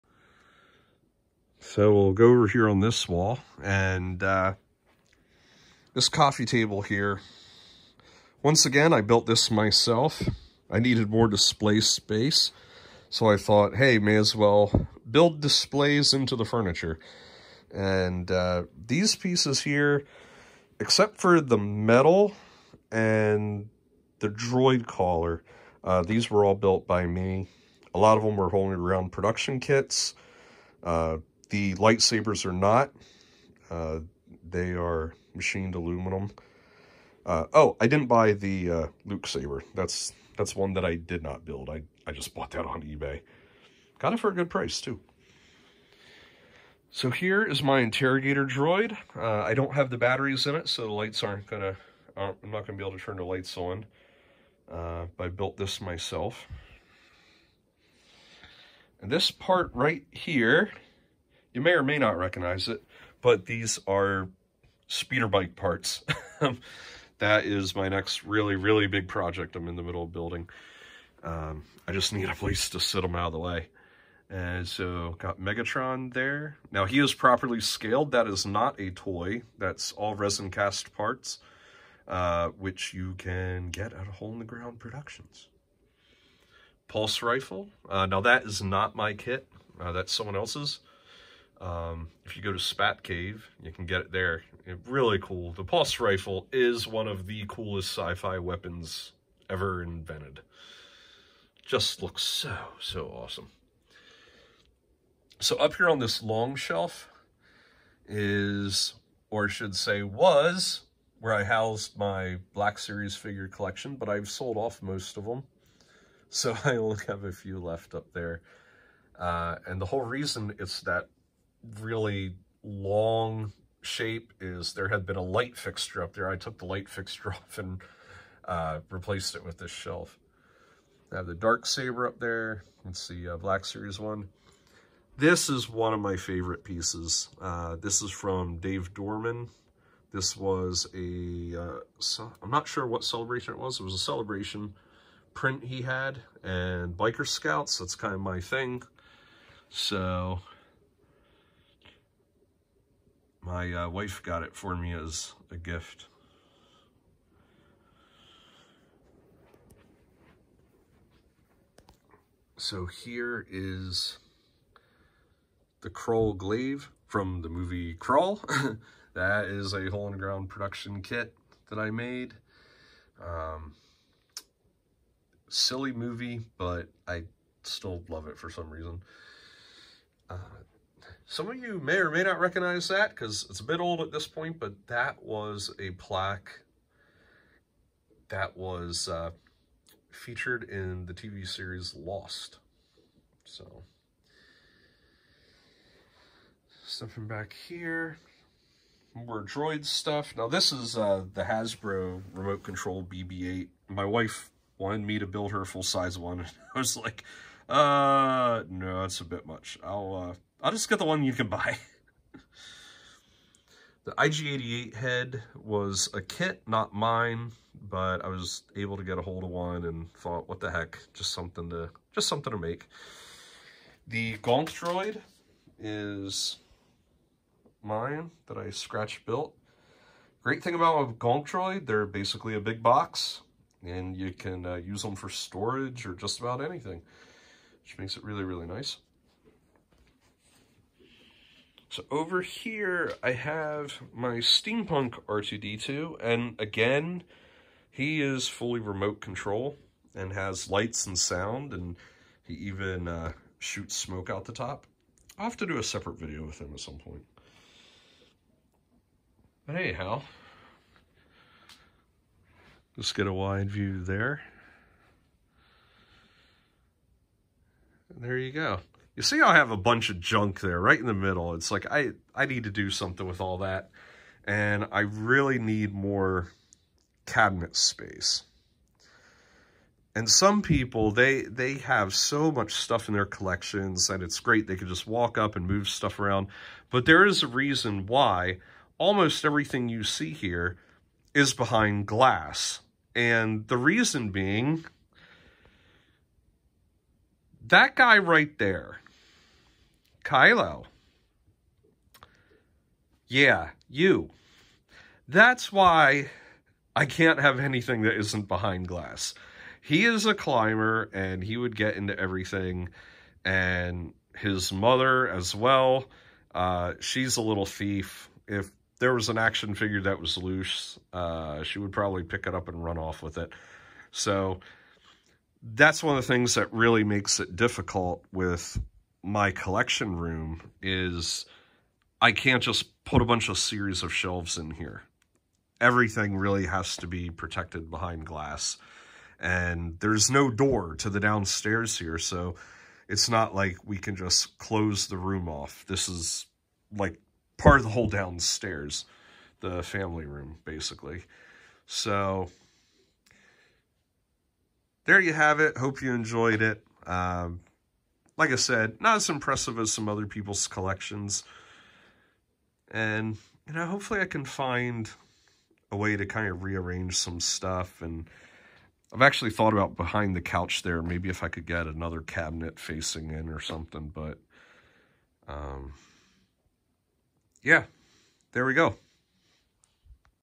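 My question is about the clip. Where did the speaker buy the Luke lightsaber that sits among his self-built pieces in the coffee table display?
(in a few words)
eBay.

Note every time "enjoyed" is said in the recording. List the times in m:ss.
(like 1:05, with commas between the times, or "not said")
5:56.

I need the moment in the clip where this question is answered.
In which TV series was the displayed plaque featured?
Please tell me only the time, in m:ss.
3:11.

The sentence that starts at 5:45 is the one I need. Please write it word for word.
This is like part of the whole downstairs, the family room, basically.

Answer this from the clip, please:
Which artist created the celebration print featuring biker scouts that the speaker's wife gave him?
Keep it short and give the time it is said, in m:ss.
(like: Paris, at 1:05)
Dave Dorman, at 2:18.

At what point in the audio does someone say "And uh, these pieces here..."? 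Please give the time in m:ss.
0:17.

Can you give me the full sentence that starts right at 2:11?
I have the Dark Saber up there.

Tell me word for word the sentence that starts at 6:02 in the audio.
And, you know, hopefully I can find a way to kind of rearrange some stuff.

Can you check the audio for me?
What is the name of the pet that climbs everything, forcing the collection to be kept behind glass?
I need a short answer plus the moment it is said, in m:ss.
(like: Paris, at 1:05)
Kylo, at 5:00.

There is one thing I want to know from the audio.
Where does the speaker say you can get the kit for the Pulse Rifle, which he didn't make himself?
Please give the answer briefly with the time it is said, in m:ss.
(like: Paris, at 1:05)
Spat Cave, at 1:32.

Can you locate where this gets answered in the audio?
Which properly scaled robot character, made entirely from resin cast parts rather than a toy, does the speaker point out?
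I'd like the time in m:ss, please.
1:15.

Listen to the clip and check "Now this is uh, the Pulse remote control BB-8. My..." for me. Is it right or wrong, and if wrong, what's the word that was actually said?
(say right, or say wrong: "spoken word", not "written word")
wrong: "Hasbro", not "Pulse".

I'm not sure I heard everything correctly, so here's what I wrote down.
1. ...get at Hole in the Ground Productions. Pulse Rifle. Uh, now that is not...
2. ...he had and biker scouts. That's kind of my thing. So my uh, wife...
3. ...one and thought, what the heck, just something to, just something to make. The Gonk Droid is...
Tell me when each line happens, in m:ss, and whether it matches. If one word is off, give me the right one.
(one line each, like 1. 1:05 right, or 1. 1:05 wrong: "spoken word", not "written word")
1. 1:23 right
2. 2:25 right
3. 3:39 right.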